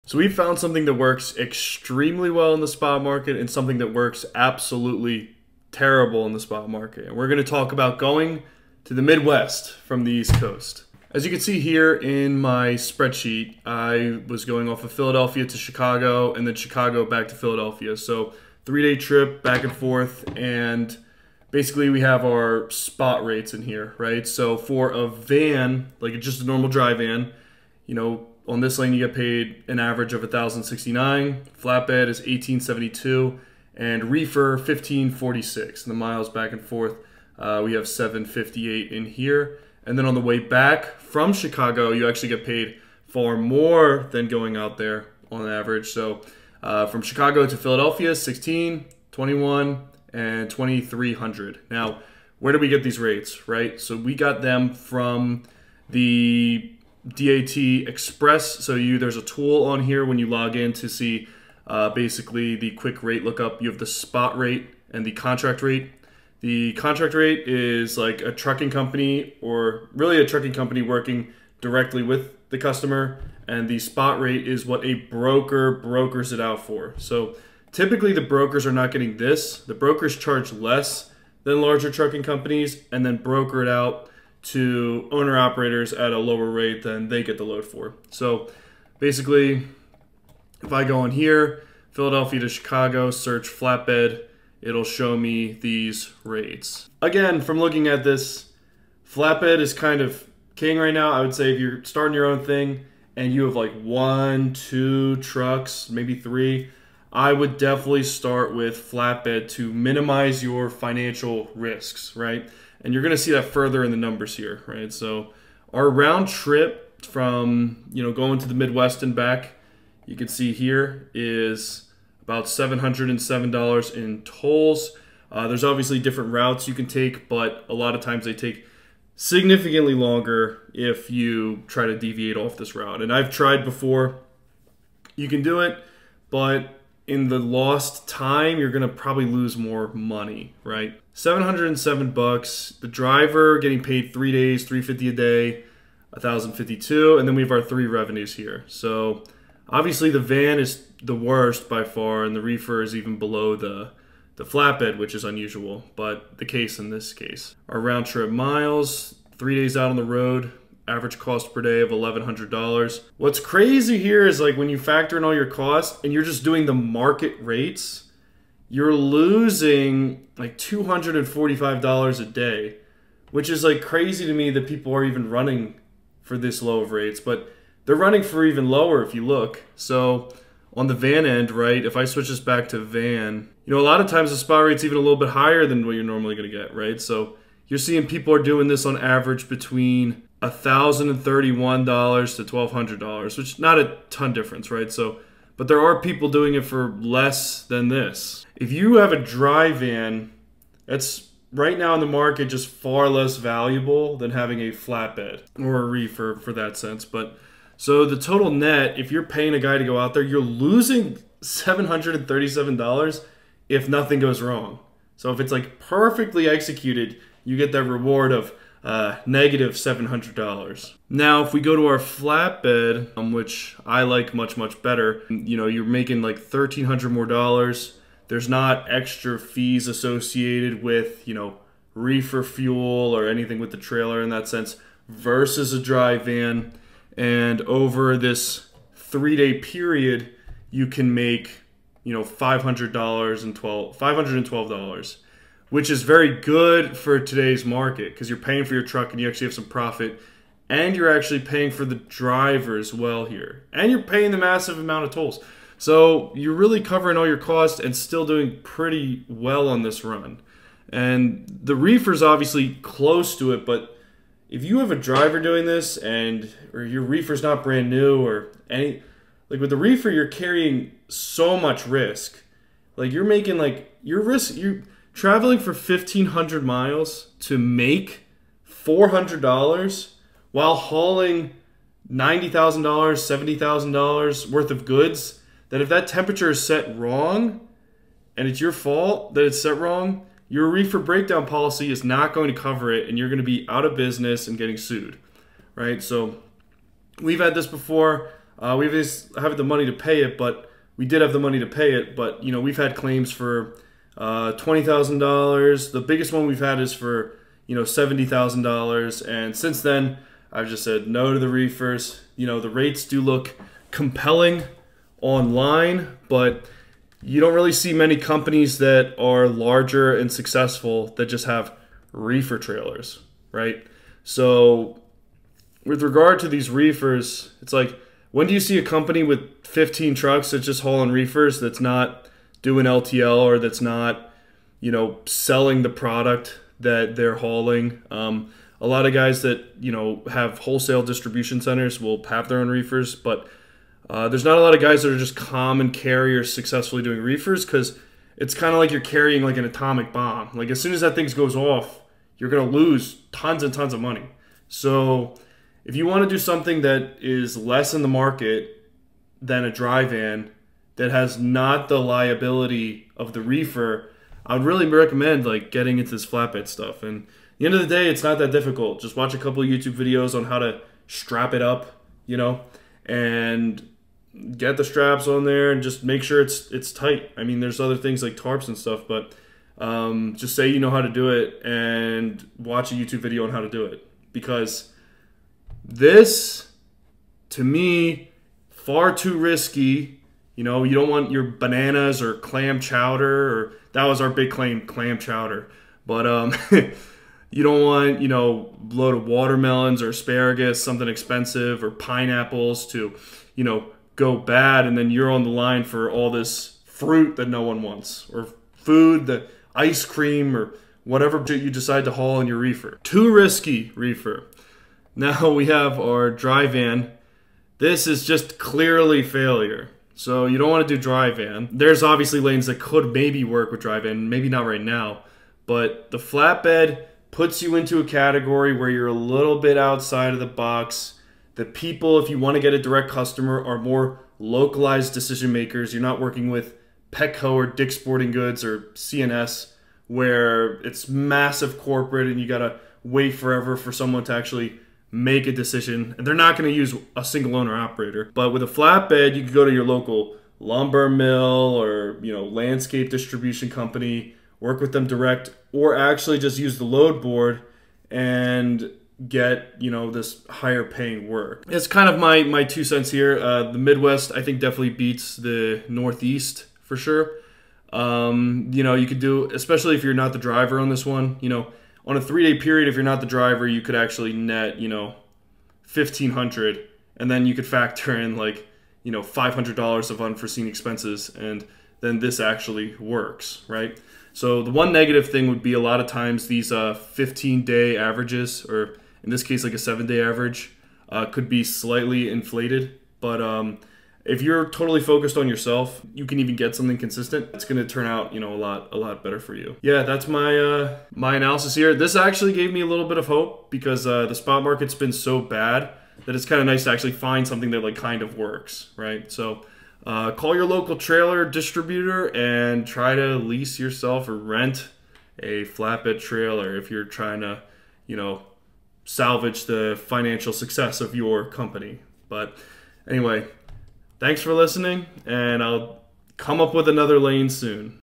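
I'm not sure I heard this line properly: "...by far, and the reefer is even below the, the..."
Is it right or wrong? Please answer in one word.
right.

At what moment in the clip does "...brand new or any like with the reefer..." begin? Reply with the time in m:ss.
4:27.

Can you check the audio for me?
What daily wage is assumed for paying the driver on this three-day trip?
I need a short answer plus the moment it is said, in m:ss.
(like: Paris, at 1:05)
350, at 2:24.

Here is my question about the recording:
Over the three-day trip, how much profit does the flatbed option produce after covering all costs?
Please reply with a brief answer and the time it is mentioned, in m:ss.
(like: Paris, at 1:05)
$512, at 4:03.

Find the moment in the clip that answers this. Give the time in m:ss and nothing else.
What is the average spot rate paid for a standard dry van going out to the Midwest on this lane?
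0:30.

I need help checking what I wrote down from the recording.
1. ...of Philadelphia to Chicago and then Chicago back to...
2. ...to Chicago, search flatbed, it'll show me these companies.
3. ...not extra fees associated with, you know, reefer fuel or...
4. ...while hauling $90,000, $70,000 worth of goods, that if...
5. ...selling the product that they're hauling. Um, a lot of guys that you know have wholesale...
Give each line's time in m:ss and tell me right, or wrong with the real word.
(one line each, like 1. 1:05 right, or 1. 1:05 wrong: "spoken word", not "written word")
1. 0:14 right
2. 1:32 wrong: "rates", not "companies"
3. 3:48 right
4. 4:40 right
5. 5:35 right.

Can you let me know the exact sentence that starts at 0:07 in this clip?
And we're going to talk about going to the Midwest from the East Coast.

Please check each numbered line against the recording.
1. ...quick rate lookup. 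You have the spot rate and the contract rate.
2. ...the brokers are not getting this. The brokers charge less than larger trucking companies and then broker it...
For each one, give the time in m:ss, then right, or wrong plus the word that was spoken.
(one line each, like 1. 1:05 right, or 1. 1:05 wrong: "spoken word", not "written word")
1. 1:02 right
2. 1:18 right.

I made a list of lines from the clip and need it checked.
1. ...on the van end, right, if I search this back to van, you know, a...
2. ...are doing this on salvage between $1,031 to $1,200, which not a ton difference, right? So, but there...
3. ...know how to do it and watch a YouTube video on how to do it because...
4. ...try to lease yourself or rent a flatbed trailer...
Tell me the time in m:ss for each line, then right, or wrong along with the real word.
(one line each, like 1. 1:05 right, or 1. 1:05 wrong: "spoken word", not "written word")
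1. 3:00 wrong: "switch", not "search"
2. 3:08 wrong: "average", not "salvage"
3. 6:20 right
4. 8:32 right.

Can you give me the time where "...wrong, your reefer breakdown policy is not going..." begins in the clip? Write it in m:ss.
4:49.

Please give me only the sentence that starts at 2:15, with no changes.
You can do it, but in the lost time, you're going to probably lose more money, right?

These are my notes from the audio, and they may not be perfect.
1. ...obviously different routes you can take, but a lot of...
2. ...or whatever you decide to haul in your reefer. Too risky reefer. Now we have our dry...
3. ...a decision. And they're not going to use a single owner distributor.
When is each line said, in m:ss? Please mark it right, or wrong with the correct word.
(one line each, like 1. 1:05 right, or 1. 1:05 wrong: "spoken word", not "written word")
1. 2:05 right
2. 6:50 right
3. 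7:25 wrong: "operator", not "distributor".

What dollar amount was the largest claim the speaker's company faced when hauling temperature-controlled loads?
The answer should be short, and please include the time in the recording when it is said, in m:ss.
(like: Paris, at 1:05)
$70,000, at 5:07.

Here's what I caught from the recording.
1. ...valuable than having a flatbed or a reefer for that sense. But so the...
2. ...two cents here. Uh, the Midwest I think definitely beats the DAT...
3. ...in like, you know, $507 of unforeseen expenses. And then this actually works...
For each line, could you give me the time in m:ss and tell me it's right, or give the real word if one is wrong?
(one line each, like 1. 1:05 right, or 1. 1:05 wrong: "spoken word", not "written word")
1. 3:23 right
2. 7:42 wrong: "Northeast", not "DAT"
3. 7:58 wrong: "500", not "507".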